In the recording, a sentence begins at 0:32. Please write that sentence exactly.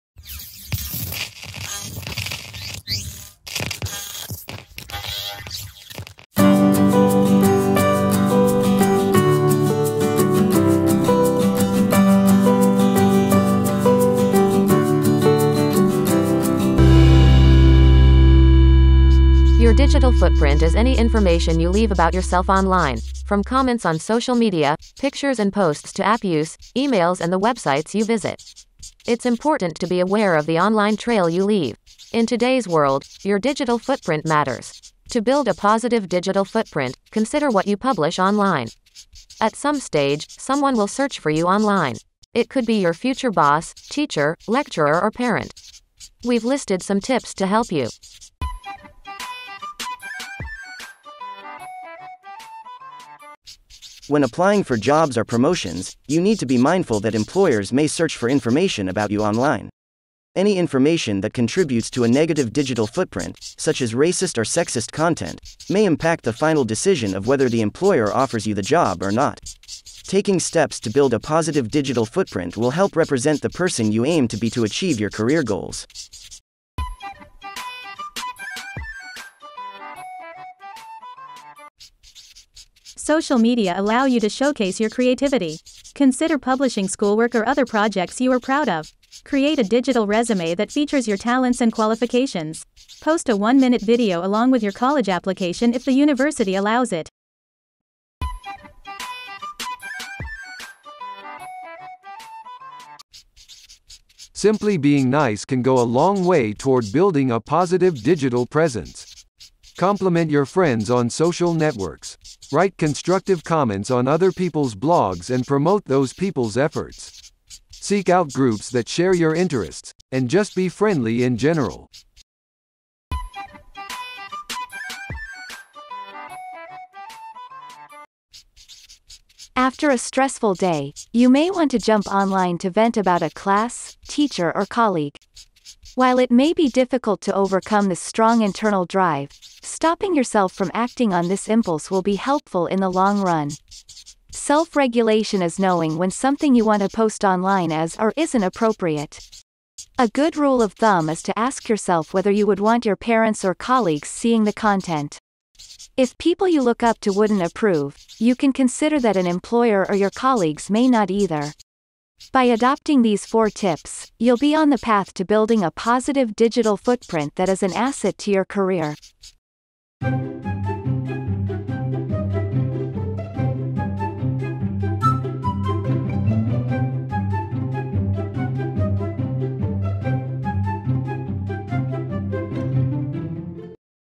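In today's world, your digital footprint matters.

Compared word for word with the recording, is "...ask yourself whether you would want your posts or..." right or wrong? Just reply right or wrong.
wrong.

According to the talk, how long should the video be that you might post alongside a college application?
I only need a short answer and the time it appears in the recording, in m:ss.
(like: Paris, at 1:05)
1 minute, at 1:33.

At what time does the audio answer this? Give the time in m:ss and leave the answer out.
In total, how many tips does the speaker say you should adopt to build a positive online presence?
2:43.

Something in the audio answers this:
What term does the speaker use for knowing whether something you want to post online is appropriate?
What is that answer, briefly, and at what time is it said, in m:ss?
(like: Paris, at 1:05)
Self-regulation, at 2:24.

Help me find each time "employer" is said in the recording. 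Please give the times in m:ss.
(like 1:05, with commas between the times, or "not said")
0:57, 1:07, 2:39.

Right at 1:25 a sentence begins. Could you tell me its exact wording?
Consider publishing schoolwork or other projects you are proud of.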